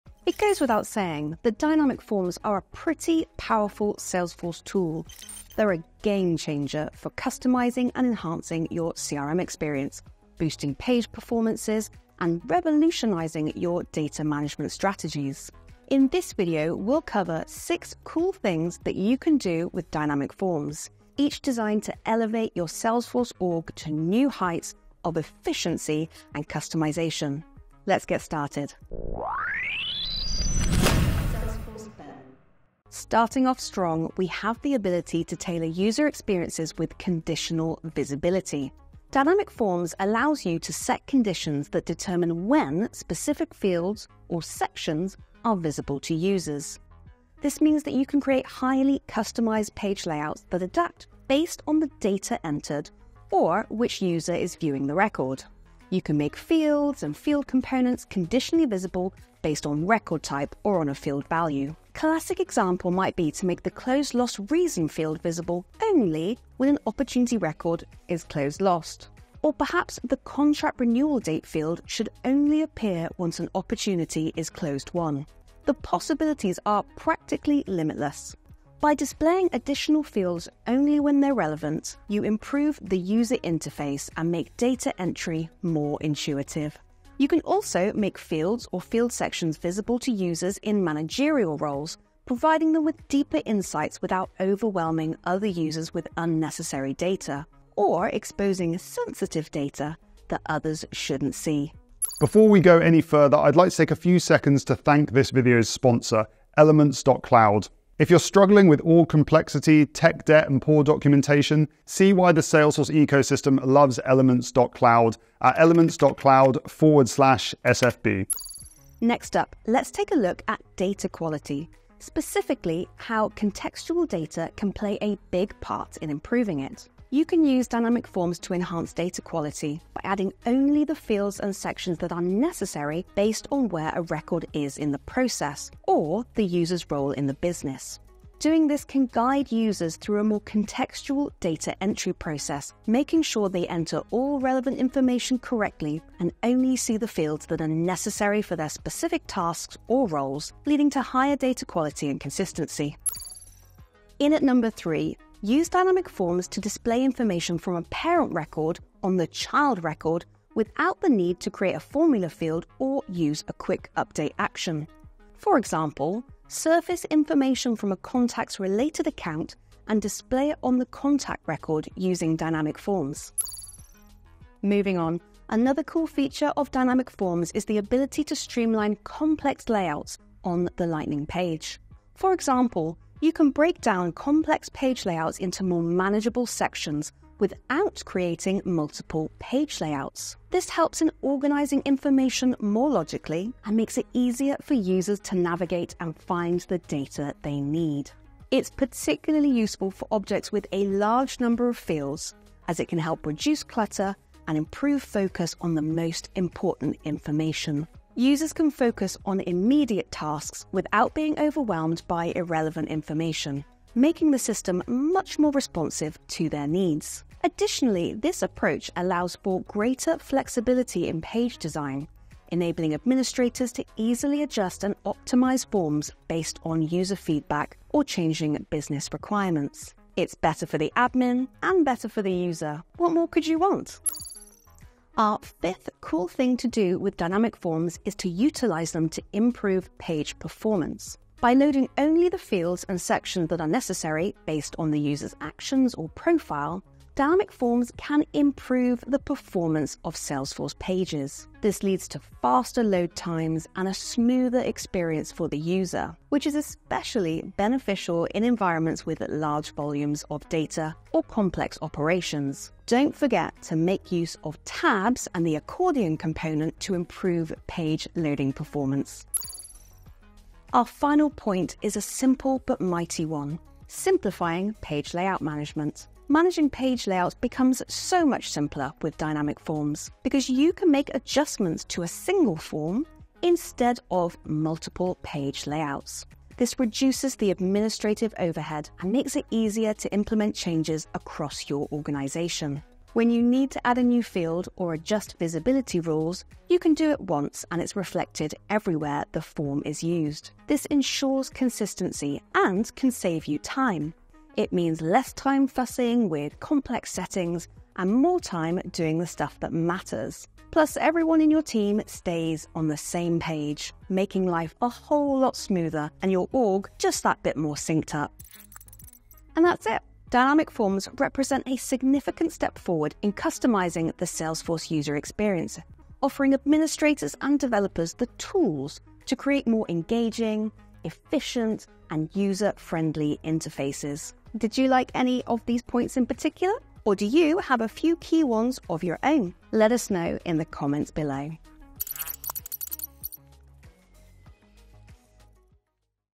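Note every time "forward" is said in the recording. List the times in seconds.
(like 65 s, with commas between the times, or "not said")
116 s, 322 s.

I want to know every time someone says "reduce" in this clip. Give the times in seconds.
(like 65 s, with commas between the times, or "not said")
203 s, 286 s.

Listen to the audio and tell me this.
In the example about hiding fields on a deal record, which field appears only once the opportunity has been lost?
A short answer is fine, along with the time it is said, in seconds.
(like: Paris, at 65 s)
Closed loss reason, at 63 s.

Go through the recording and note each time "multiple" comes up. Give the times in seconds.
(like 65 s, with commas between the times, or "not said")
188 s, 284 s.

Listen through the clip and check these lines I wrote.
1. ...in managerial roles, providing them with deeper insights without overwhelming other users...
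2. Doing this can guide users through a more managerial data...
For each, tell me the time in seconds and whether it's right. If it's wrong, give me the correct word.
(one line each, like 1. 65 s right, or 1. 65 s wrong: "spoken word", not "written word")
1. 90 s right
2. 138 s wrong: "contextual", not "managerial".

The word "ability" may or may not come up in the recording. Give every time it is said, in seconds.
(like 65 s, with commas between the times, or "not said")
34 s, 177 s.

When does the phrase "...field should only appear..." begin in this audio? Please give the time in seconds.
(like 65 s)
71 s.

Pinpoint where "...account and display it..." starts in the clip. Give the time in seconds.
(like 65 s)
169 s.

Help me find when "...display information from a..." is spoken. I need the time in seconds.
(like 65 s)
156 s.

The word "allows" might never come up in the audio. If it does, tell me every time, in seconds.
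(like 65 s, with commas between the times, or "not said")
40 s, 218 s.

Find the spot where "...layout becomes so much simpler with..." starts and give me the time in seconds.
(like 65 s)
277 s.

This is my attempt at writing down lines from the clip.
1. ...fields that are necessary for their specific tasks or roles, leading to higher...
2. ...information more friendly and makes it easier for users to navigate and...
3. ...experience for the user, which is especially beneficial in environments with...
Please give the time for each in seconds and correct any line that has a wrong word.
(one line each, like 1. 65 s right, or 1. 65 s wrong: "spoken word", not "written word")
1. 147 s right
2. 191 s wrong: "logically", not "friendly"
3. 254 s right.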